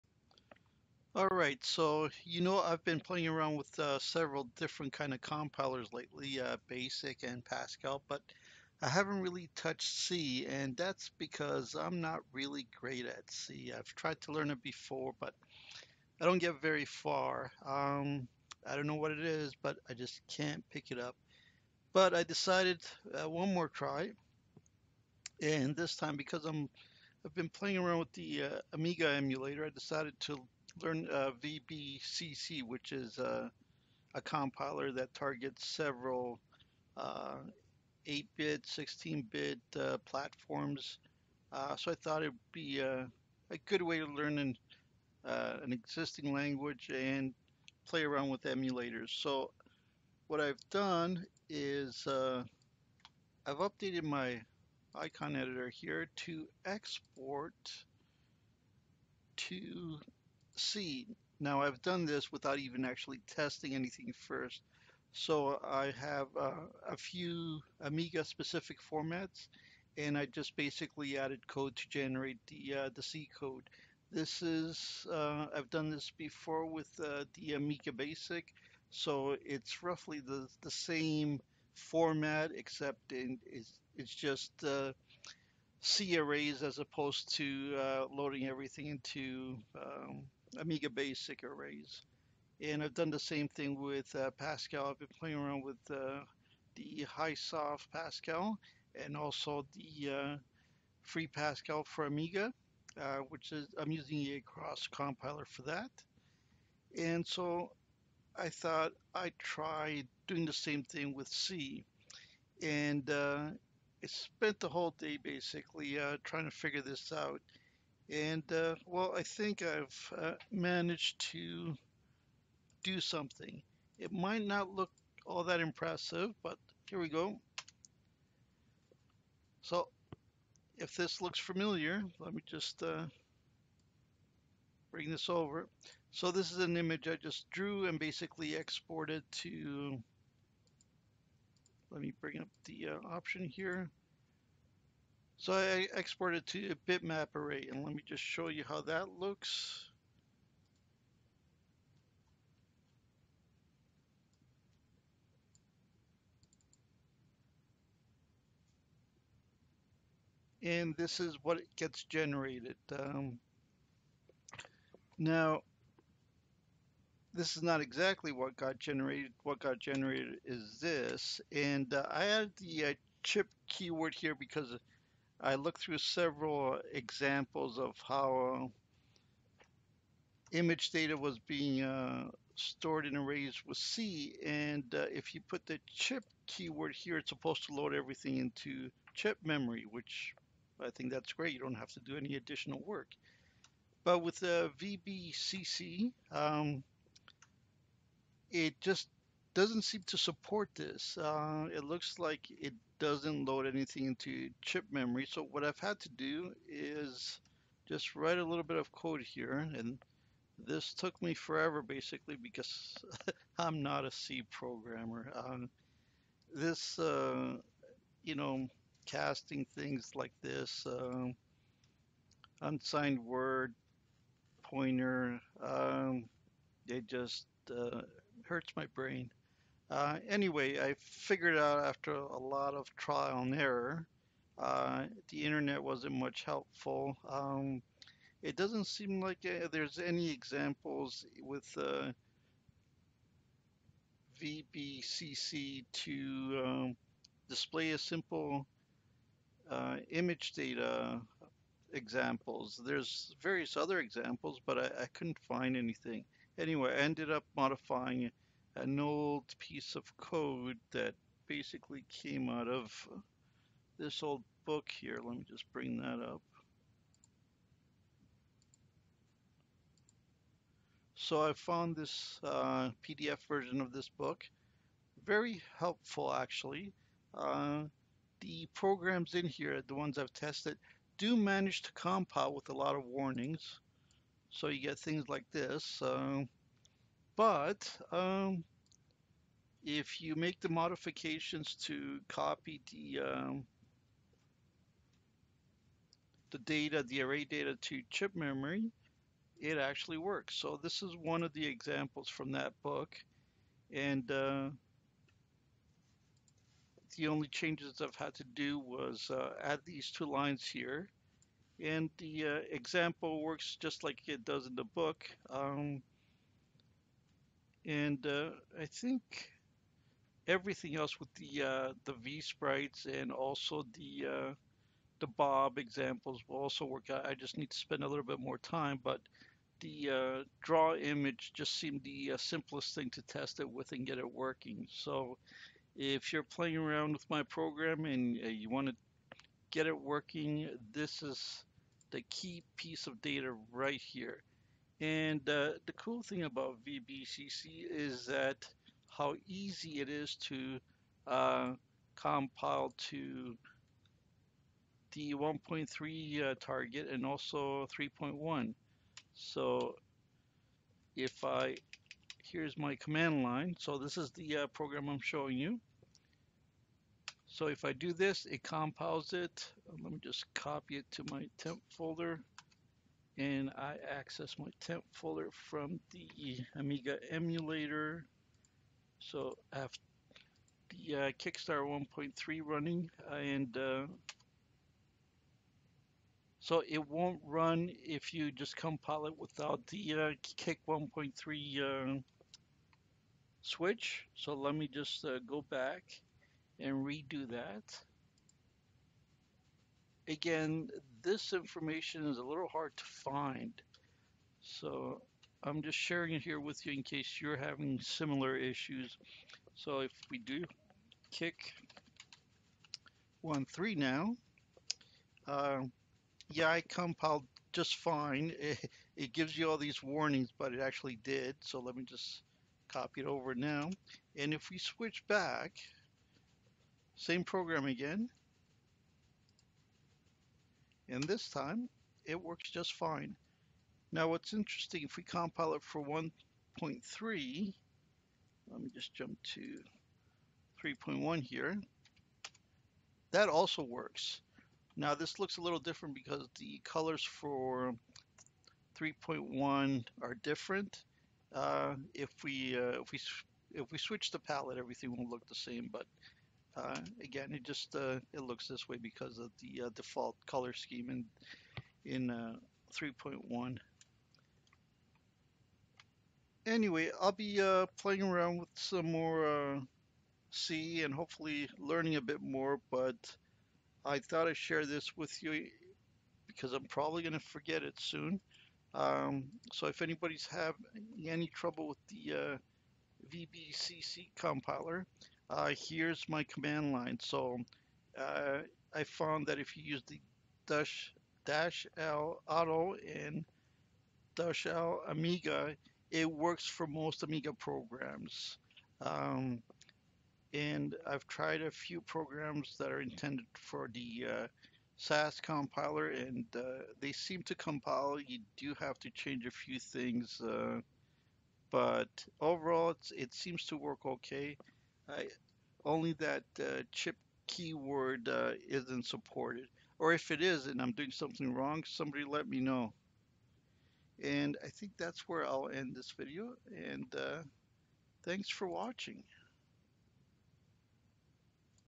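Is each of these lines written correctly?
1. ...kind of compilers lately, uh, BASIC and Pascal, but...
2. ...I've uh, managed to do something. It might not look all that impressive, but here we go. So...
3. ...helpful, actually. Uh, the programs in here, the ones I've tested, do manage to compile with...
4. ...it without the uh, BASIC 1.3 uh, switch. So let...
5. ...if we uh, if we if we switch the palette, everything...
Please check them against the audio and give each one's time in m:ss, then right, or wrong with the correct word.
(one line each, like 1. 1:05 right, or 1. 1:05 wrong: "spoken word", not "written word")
1. 0:04 right
2. 1:59 right
3. 4:35 right
4. 6:29 wrong: "Kick", not "BASIC"
5. 7:32 right.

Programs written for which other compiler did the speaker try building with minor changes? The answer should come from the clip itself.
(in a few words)
SAS.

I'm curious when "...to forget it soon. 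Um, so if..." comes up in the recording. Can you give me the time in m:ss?
7:57.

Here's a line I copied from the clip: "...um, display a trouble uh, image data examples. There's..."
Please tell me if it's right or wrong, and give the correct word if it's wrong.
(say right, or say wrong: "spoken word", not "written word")
wrong: "simple", not "trouble".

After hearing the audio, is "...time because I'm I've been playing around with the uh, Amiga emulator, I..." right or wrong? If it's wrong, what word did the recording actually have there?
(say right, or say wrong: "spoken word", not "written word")
right.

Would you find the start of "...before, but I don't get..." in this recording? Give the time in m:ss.
0:14.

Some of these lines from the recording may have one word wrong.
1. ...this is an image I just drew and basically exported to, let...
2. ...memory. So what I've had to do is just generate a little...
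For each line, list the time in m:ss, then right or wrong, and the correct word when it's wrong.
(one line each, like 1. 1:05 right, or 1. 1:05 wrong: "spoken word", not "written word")
1. 2:16 right
2. 3:24 wrong: "write", not "generate".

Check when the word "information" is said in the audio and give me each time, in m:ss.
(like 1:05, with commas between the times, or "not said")
6:41.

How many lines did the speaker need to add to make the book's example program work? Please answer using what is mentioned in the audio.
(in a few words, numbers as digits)
2.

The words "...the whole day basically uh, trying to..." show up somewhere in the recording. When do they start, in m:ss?
1:54.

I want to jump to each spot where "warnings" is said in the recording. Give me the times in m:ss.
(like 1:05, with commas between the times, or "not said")
4:43, 7:00.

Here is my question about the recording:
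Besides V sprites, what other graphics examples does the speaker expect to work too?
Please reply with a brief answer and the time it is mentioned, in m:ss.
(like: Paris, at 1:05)
Bob examples, at 5:25.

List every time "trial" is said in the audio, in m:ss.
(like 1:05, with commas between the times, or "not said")
3:52.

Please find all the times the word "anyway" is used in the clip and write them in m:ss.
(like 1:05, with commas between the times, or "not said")
3:50, 4:16, 7:46.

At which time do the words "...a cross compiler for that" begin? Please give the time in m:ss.
1:44.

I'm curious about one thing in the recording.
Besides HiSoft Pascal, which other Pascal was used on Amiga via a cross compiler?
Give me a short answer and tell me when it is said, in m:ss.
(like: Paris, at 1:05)
Free Pascal, at 1:41.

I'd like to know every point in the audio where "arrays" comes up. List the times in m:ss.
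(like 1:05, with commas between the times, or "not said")
1:26, 1:31, 2:27, 3:03, 4:57.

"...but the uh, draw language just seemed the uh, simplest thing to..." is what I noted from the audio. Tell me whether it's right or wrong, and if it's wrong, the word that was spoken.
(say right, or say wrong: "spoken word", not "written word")
wrong: "image", not "language".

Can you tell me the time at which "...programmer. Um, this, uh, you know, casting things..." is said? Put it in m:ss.
3:34.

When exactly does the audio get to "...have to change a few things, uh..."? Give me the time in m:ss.
8:28.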